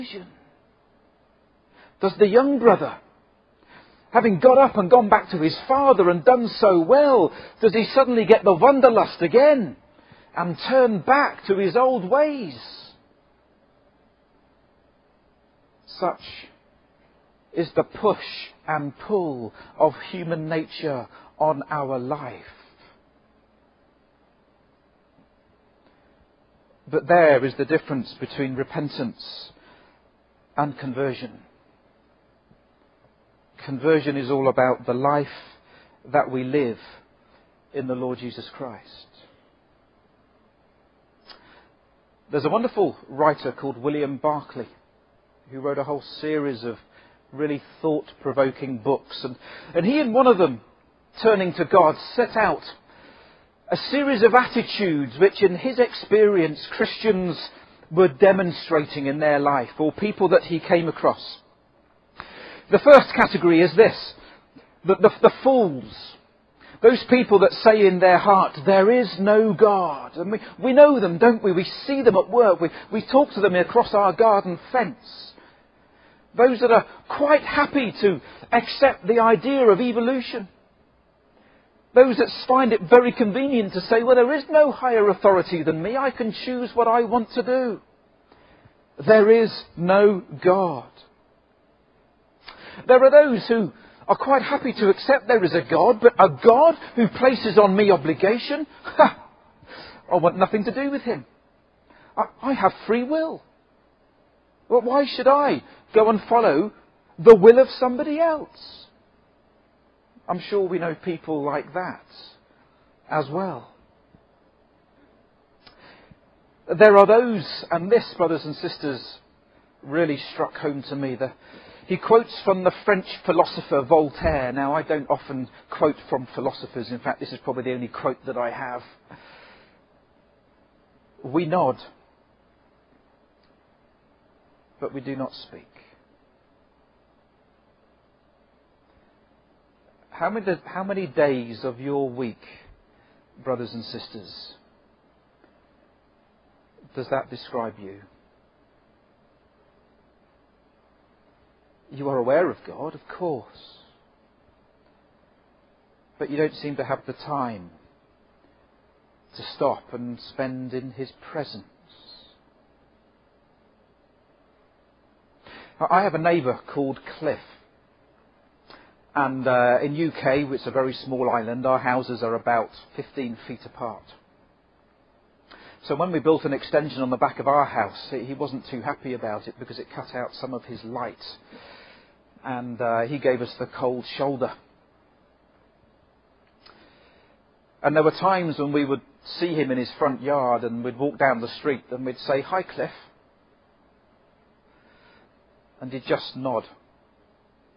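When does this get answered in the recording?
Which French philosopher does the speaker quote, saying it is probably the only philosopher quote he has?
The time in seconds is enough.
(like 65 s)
123 s.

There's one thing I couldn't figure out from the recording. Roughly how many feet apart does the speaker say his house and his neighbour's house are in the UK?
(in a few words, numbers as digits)
15 feet.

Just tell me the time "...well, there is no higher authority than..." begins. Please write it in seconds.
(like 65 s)
84 s.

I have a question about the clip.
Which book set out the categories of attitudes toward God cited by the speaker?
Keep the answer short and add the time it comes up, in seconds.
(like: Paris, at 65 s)
Turning to God, at 51 s.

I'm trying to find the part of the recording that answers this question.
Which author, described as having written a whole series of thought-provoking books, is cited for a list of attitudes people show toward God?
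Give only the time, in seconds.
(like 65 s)
43 s.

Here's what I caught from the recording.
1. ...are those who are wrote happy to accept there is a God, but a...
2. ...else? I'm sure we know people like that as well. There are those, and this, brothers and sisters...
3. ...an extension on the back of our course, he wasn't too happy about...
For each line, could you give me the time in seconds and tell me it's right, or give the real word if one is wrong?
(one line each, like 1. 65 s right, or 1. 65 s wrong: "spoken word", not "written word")
1. 93 s wrong: "quite", not "wrote"
2. 108 s right
3. 176 s wrong: "house", not "course".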